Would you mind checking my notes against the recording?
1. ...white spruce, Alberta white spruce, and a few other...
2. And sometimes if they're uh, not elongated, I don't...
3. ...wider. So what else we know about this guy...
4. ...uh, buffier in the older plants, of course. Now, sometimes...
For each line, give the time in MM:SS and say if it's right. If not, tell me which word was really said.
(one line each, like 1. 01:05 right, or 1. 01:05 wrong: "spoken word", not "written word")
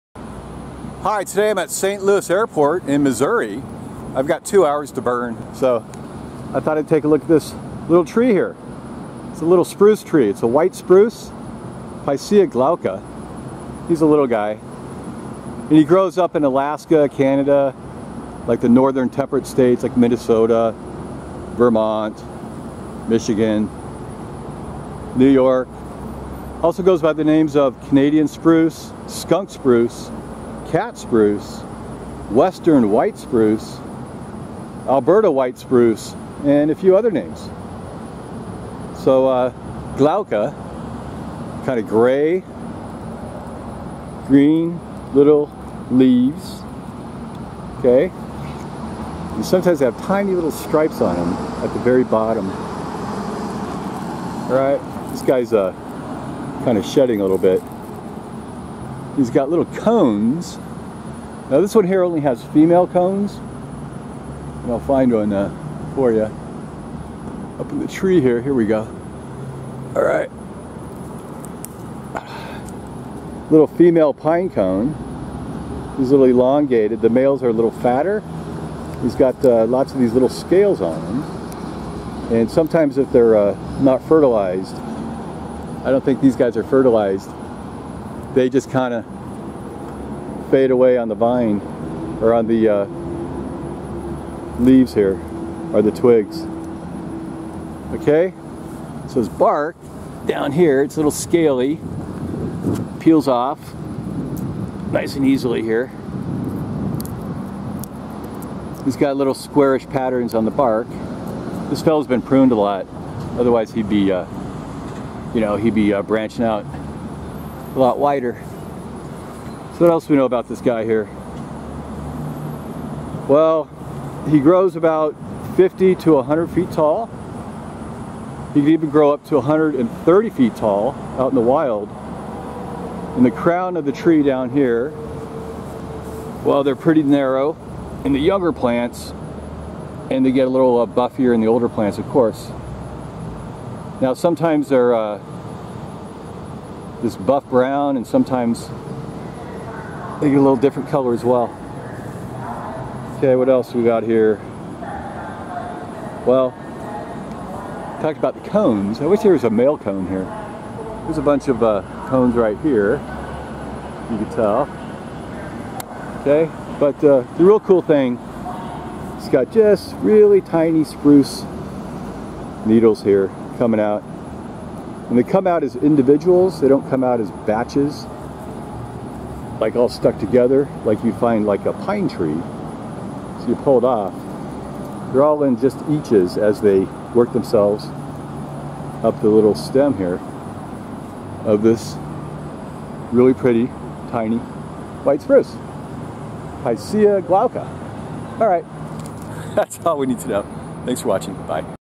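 1. 00:32 right
2. 01:22 wrong: "fertilized", not "elongated"
3. 01:57 right
4. 02:20 right.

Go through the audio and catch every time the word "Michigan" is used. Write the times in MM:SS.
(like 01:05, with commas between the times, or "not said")
00:23.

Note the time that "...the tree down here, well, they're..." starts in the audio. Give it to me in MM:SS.
02:13.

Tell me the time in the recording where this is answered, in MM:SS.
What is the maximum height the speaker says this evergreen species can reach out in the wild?
02:09.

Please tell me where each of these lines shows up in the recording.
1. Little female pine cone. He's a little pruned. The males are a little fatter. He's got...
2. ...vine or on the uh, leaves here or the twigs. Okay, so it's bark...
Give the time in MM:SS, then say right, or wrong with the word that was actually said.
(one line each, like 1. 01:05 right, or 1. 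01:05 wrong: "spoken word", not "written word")
1. 01:13 wrong: "elongated", not "pruned"
2. 01:31 right.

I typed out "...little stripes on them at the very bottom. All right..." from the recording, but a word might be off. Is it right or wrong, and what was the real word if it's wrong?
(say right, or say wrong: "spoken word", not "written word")
right.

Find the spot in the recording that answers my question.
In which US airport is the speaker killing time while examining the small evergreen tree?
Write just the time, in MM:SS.
00:01.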